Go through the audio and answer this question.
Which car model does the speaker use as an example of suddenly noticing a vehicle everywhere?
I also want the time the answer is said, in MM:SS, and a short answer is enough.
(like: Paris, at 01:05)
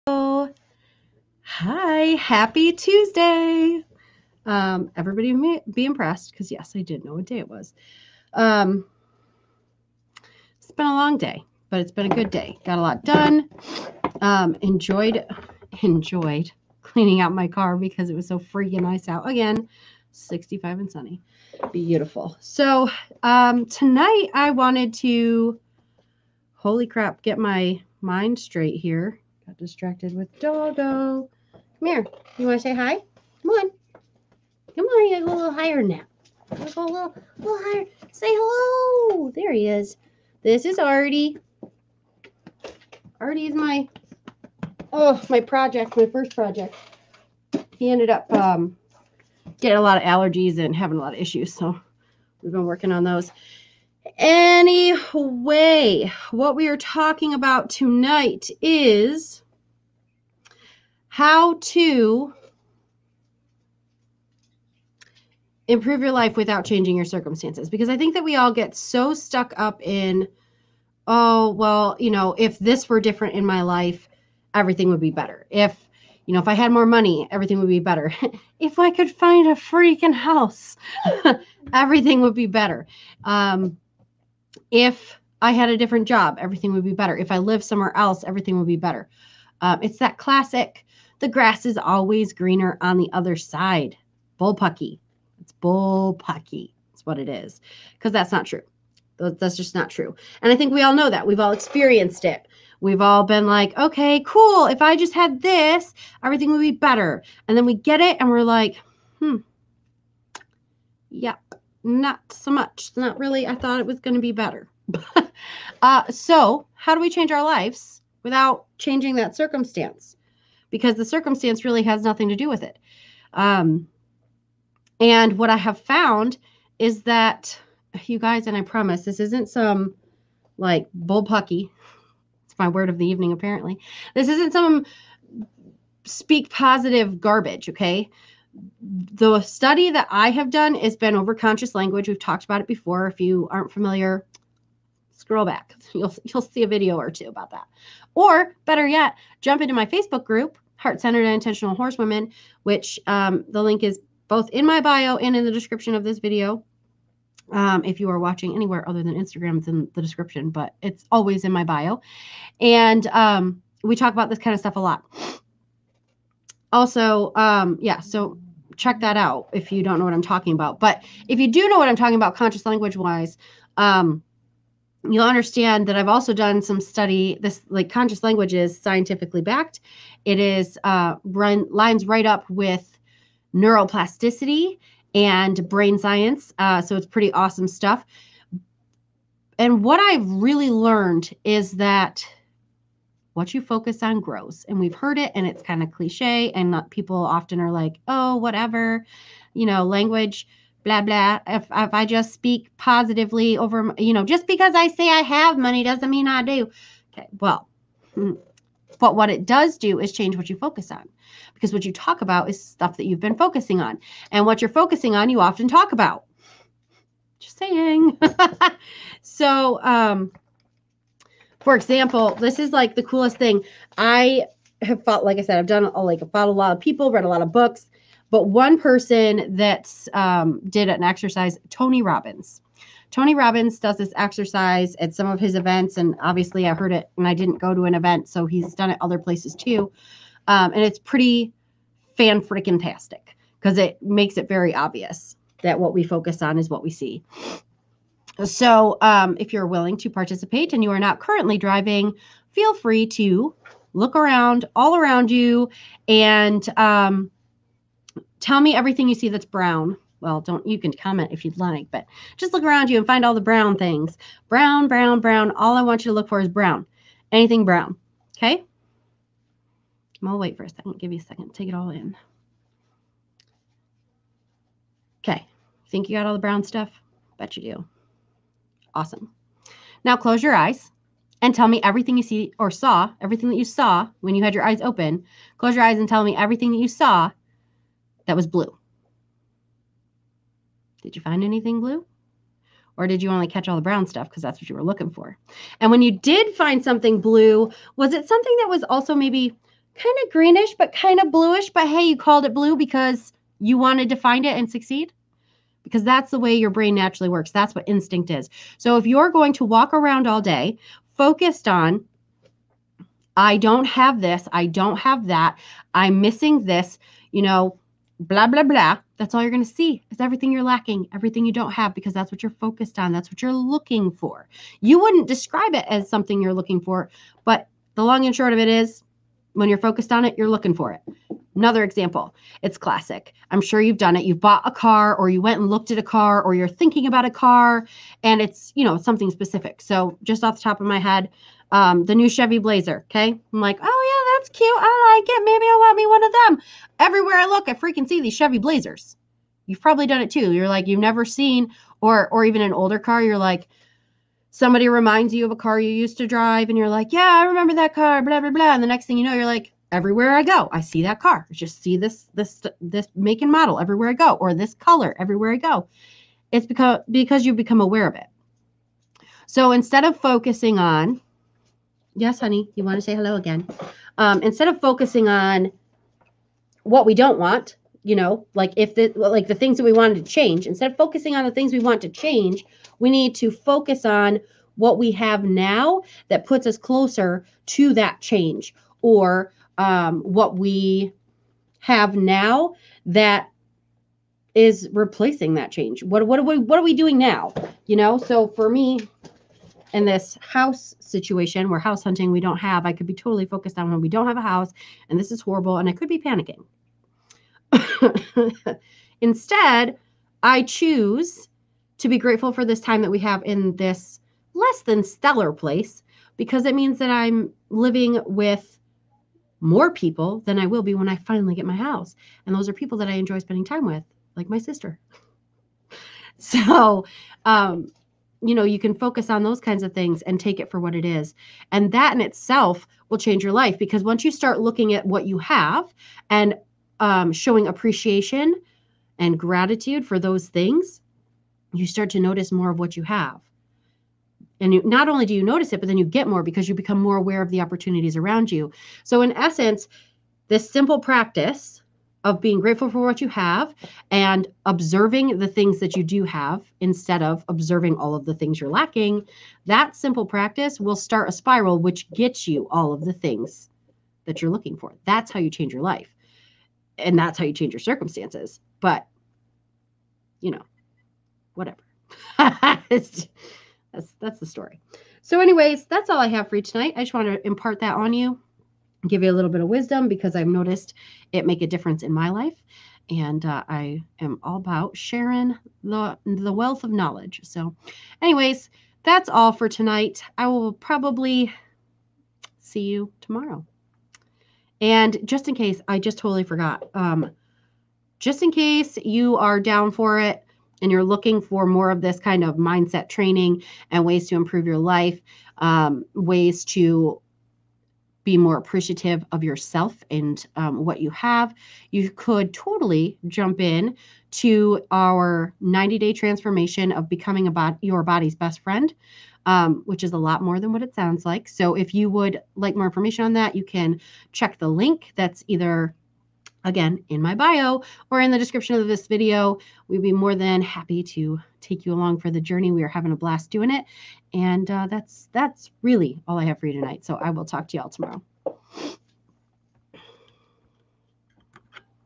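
Chevy Blazer, at 05:42.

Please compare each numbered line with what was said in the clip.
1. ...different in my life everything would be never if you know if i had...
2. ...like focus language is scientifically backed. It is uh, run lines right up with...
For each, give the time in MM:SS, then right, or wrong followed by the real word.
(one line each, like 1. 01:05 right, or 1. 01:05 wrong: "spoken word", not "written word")
1. 01:13 wrong: "better", not "never"
2. 02:57 wrong: "conscious", not "focus".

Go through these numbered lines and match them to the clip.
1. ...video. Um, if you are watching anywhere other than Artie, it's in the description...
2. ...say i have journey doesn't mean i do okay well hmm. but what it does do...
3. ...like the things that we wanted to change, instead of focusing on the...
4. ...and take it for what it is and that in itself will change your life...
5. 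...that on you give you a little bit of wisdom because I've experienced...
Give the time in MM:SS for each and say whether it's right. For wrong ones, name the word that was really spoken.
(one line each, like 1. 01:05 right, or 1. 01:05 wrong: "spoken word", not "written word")
1. 02:36 wrong: "Instagram", not "Artie"
2. 03:24 wrong: "money", not "journey"
3. 06:19 right
4. 07:10 right
5. 07:57 wrong: "noticed", not "experienced".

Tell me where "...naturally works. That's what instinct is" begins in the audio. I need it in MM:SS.
05:06.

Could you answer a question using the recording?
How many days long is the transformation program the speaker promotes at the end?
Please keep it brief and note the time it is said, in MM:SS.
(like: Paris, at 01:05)
90, at 08:35.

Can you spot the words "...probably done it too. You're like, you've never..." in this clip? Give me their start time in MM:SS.
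05:49.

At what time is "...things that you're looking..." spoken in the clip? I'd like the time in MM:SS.
07:43.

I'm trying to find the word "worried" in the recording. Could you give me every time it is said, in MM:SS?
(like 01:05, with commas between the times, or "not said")
not said.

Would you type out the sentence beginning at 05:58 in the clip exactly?
And the next thing you know, you're like, everywhere I go, I see that car.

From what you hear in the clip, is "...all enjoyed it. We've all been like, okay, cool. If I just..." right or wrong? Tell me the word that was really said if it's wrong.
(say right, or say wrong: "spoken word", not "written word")
wrong: "experienced", not "enjoyed".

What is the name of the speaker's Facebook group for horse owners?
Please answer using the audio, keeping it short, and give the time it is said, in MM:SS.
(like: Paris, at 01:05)
Heart Centered and Intentional Horsewomen, at 02:30.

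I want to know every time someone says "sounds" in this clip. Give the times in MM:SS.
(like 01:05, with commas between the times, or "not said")
08:40.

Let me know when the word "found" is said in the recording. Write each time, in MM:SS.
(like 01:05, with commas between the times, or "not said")
02:05.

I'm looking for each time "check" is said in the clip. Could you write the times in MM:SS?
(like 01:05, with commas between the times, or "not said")
02:48, 08:44.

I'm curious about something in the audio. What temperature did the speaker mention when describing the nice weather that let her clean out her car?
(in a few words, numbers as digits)
65.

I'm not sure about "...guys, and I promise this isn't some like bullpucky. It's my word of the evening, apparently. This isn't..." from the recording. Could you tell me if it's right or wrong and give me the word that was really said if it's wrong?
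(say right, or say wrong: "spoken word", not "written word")
right.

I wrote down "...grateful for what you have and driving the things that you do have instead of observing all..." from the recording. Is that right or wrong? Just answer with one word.
wrong.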